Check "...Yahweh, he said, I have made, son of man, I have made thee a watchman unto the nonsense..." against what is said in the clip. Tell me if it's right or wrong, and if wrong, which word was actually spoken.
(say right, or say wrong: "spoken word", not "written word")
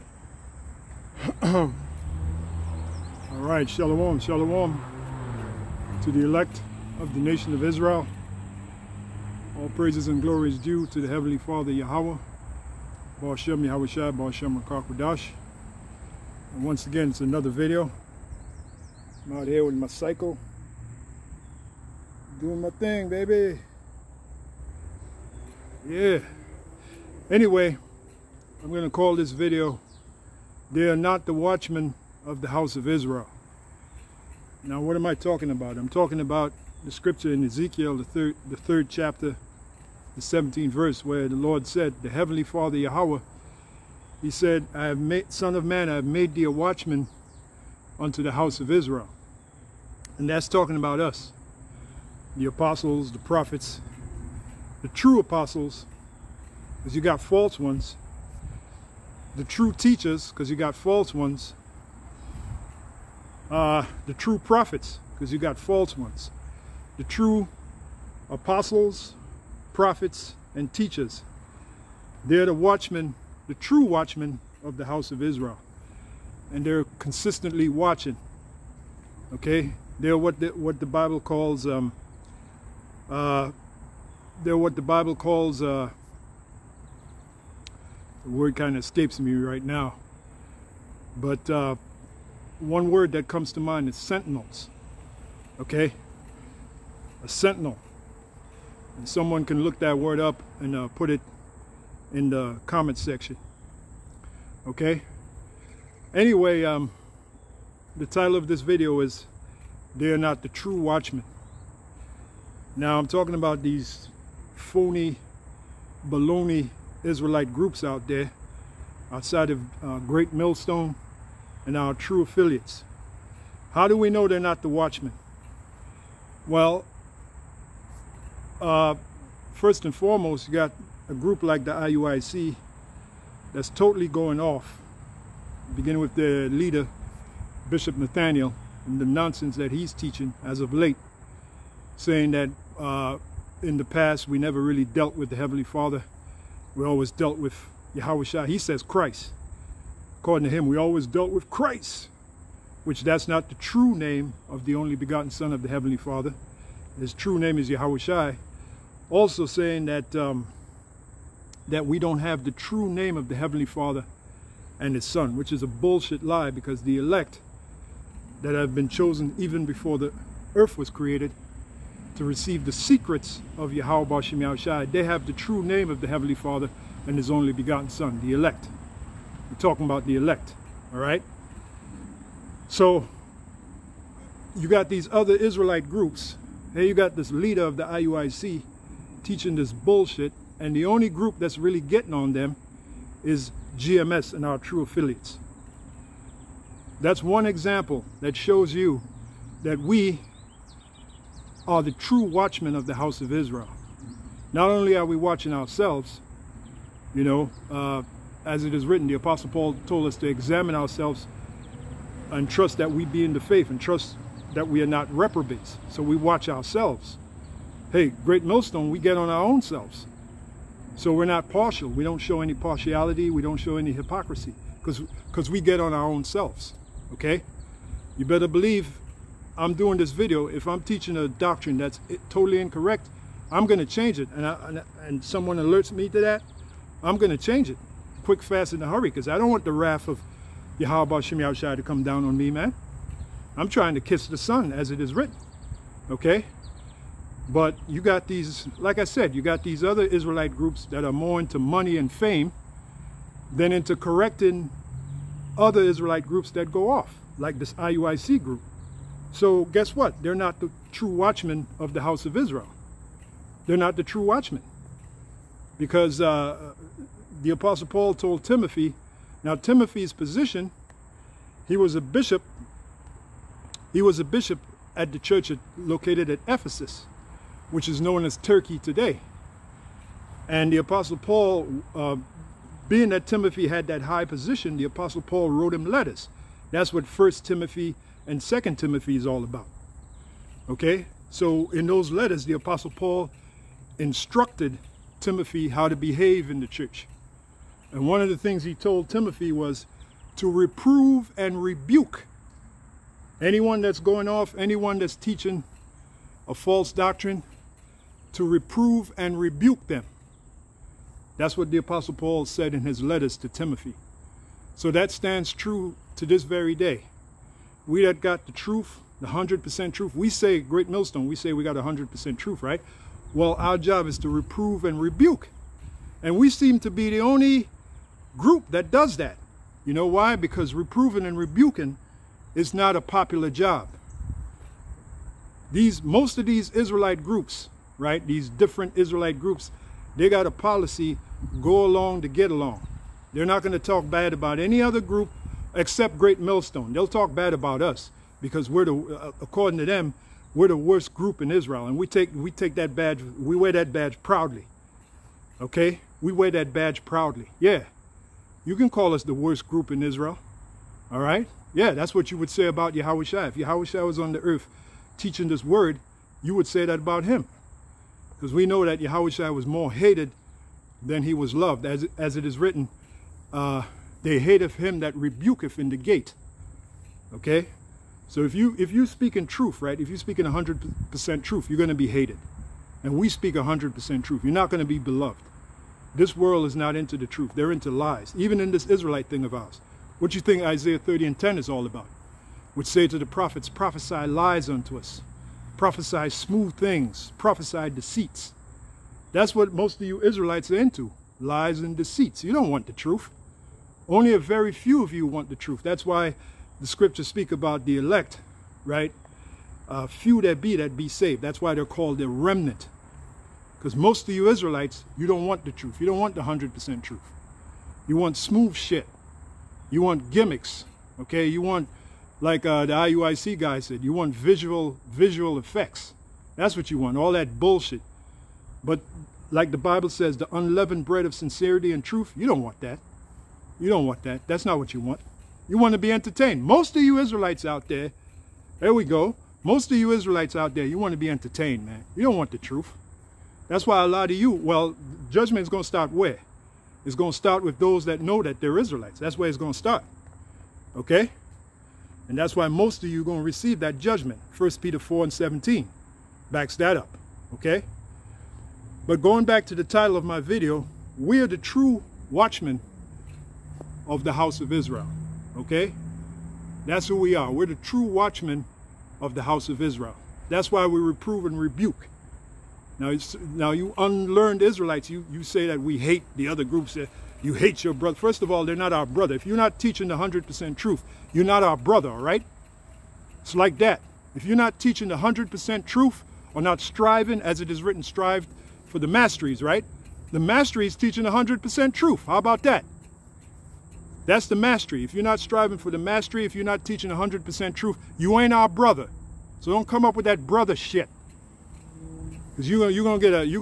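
wrong: "house", not "nonsense".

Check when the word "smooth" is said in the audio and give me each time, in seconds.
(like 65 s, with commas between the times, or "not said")
396 s, 418 s.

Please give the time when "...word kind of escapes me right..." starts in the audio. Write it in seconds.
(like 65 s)
88 s.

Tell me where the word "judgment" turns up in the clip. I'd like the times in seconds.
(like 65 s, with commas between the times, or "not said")
445 s, 453 s.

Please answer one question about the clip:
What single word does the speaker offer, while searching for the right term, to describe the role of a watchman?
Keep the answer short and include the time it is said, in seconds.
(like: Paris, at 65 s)
Sentinels, at 93 s.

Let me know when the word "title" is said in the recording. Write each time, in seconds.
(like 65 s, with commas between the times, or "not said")
108 s, 459 s.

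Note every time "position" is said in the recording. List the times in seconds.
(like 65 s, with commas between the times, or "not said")
270 s, 284 s.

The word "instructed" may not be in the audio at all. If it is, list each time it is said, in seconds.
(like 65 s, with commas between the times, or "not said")
293 s.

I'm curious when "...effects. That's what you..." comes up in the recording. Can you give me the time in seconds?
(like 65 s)
425 s.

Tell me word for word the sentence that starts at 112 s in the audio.
Now, I'm talking about these phony, baloney Israelite groups out there outside of uh, Great Millstone and our true affiliates.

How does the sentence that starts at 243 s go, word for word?
I'm trying to kiss the Son as it is written, okay?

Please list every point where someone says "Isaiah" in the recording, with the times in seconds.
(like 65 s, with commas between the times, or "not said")
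390 s.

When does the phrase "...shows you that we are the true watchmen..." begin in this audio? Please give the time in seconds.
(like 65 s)
198 s.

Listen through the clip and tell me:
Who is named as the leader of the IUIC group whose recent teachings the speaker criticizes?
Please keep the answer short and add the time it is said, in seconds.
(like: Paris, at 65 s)
Bishop Nathaniel, at 137 s.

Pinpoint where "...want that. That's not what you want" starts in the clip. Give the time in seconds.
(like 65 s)
434 s.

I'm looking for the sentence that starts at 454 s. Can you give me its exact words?
1 Peter 4 and 17 backs that up.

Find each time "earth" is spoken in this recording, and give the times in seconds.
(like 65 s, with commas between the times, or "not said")
170 s, 364 s.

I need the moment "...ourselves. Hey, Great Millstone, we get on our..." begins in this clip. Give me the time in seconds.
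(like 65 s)
216 s.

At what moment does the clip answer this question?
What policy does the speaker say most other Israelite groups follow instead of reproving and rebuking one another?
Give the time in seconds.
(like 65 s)
341 s.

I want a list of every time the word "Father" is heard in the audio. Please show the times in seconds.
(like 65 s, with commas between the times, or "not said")
11 s, 42 s, 145 s, 155 s, 163 s, 176 s.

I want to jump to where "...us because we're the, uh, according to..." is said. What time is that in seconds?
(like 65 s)
347 s.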